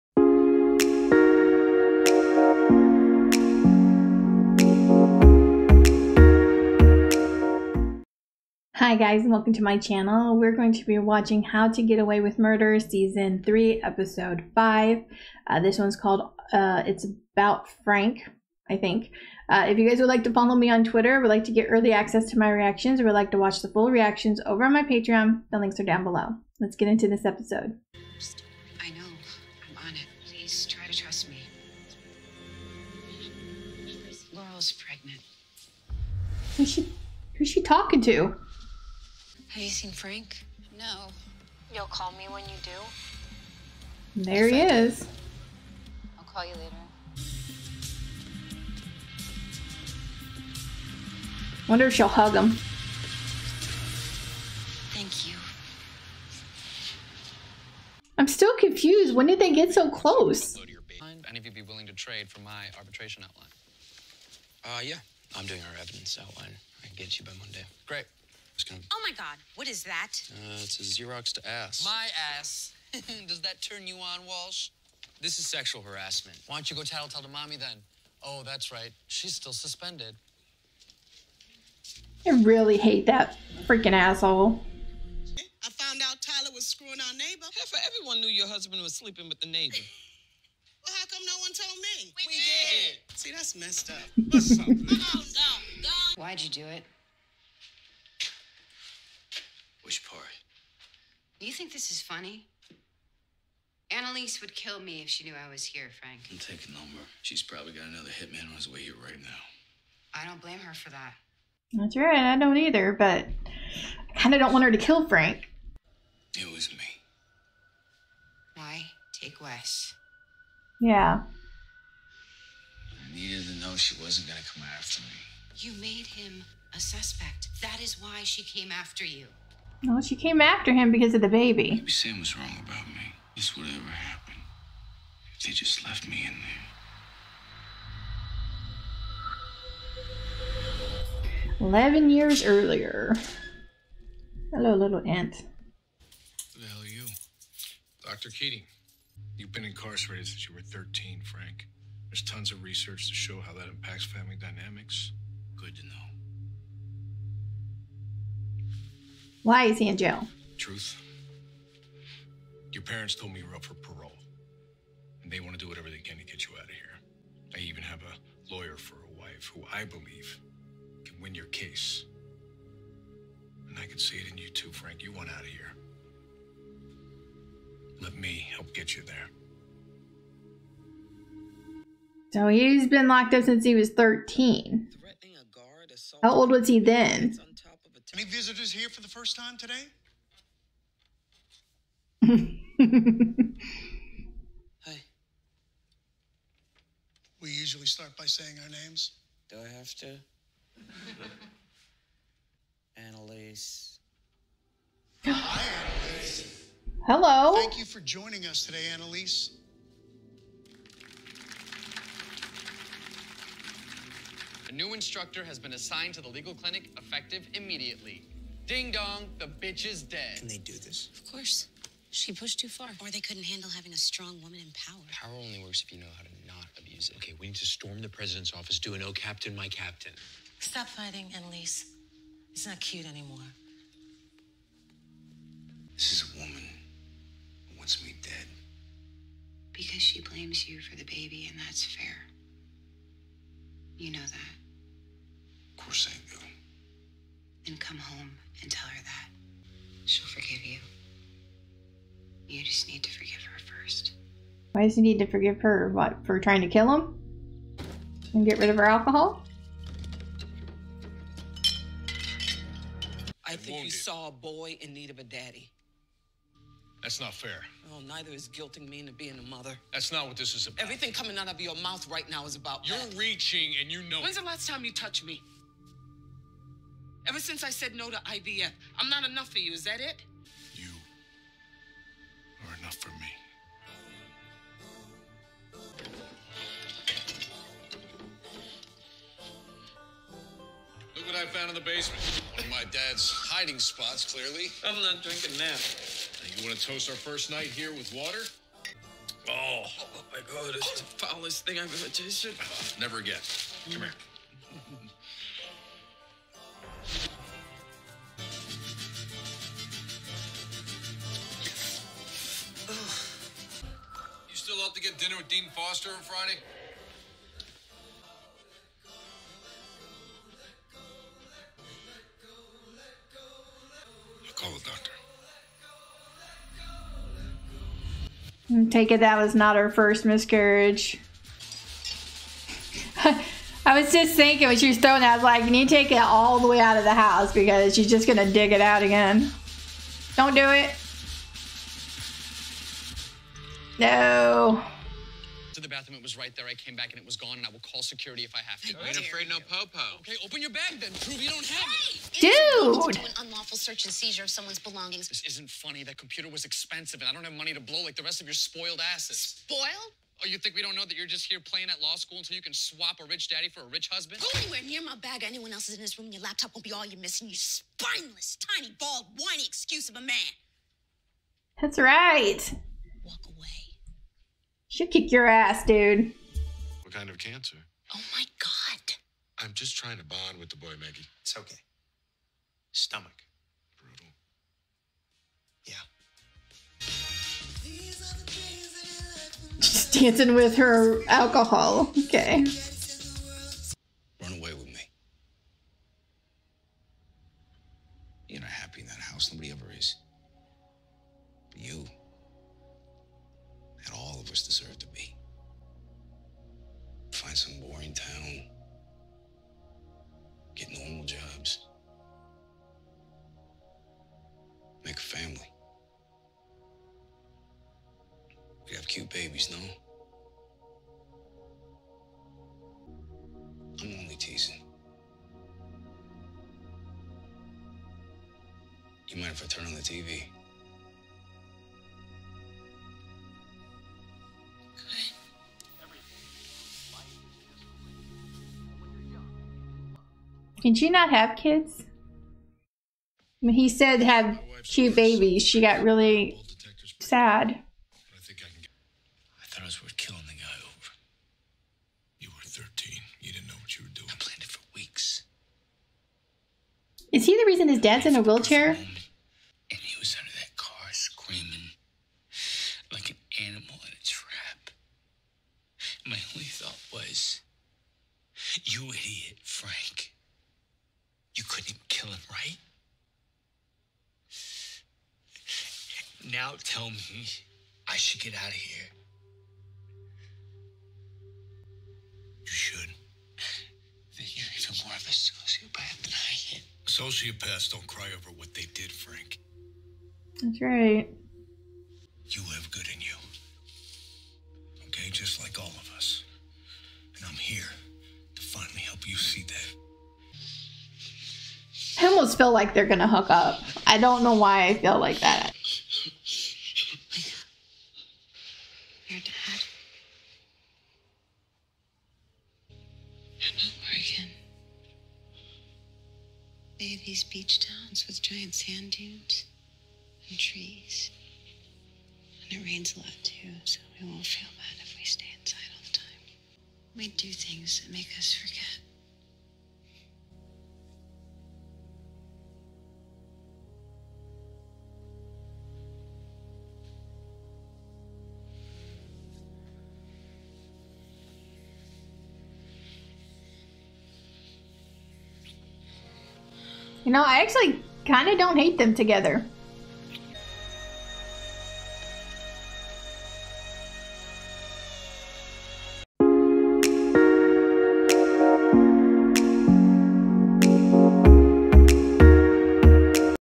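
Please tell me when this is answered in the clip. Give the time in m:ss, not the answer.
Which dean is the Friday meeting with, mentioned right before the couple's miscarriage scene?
5:15.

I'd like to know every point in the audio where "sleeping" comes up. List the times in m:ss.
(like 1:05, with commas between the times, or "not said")
1:28.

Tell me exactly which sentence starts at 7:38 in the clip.
And he was under that car screaming like an animal in a trap.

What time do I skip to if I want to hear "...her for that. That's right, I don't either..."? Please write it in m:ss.
1:50.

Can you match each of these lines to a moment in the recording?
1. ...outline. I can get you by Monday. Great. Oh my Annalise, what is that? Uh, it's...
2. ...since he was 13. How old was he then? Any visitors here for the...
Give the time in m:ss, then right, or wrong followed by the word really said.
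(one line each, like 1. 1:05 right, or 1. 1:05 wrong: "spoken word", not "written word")
1. 1:06 wrong: "God", not "Annalise"
2. 3:03 right.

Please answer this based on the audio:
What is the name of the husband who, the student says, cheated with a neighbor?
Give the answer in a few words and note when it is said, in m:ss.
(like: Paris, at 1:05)
Tyler, at 1:26.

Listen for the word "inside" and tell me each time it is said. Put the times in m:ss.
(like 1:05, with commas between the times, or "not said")
8:45.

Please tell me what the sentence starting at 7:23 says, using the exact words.
I mean, he said have two babies.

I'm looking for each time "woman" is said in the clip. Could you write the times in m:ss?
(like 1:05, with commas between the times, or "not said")
3:44, 3:56.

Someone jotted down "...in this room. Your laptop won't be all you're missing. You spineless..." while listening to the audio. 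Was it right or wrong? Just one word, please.
right.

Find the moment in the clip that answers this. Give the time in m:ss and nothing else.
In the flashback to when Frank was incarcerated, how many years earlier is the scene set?
2:21.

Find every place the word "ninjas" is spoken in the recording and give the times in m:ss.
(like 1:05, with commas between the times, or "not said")
not said.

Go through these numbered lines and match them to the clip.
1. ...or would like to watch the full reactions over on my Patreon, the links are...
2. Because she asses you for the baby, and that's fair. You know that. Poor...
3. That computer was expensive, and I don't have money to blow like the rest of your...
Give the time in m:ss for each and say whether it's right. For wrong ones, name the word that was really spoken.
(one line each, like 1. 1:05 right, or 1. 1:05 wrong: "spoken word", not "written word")
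1. 0:22 right
2. 3:59 wrong: "blames", not "asses"
3. 5:56 right.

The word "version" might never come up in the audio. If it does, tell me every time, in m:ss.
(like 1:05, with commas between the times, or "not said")
not said.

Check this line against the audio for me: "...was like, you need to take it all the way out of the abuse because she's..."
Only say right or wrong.
wrong.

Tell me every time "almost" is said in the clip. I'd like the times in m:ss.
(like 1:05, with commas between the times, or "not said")
8:22.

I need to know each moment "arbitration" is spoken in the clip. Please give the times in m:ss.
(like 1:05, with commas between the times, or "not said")
1:02.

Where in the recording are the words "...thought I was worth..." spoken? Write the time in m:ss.
7:29.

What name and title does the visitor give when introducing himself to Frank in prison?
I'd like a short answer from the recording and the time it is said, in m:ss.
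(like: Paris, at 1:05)
Dr. Keating, at 2:28.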